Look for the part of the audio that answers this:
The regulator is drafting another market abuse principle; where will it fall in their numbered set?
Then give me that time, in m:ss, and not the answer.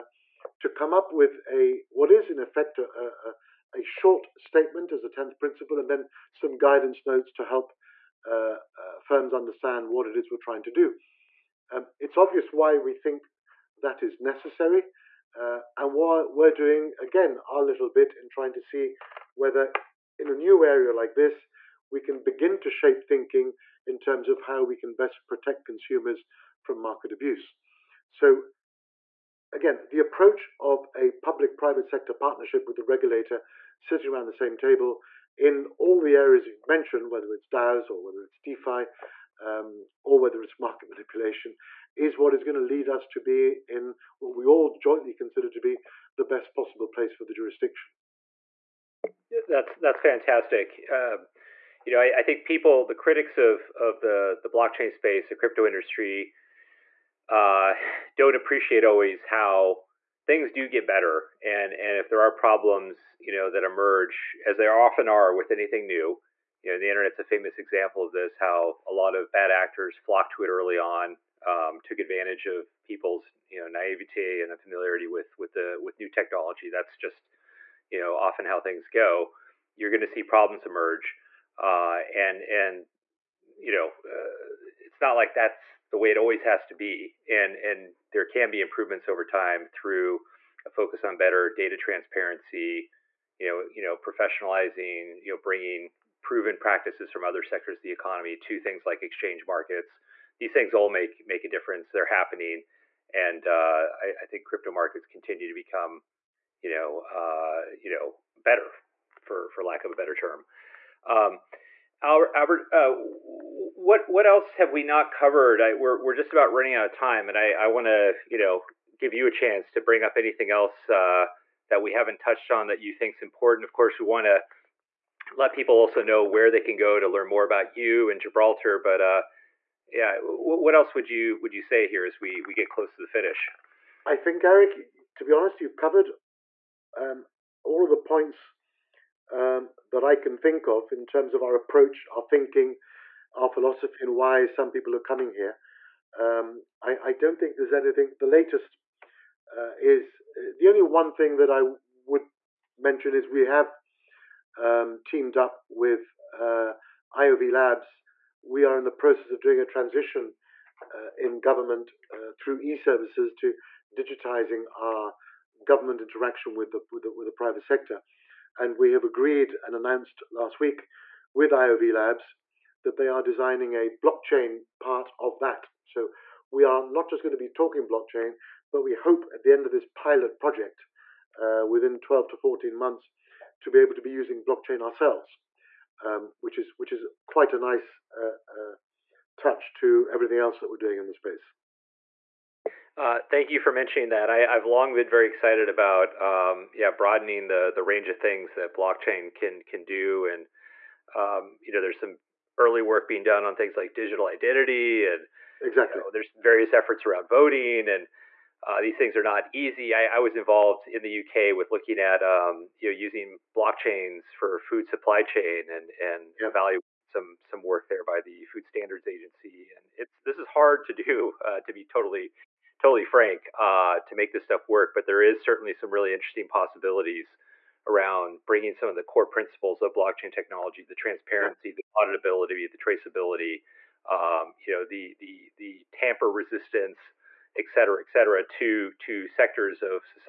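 0:05.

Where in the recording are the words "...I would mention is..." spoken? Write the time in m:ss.
2:31.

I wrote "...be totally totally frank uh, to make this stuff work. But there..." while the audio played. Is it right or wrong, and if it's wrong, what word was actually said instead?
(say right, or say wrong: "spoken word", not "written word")
right.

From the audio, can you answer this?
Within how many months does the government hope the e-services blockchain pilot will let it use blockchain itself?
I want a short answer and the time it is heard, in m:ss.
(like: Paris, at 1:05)
12 to 14 months, at 3:01.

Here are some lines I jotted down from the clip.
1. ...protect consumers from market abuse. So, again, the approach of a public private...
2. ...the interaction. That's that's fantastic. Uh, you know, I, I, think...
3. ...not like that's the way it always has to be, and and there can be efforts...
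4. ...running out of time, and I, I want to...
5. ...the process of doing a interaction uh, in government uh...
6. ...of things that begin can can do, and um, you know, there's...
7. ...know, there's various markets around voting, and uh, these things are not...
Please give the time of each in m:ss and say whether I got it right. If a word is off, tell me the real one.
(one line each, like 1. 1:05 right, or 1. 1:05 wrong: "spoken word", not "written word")
1. 0:25 right
2. 0:47 wrong: "jurisdiction", not "interaction"
3. 1:24 wrong: "improvements", not "efforts"
4. 1:56 right
5. 2:38 wrong: "transition", not "interaction"
6. 3:18 wrong: "blockchain", not "begin"
7. 3:26 wrong: "efforts", not "markets".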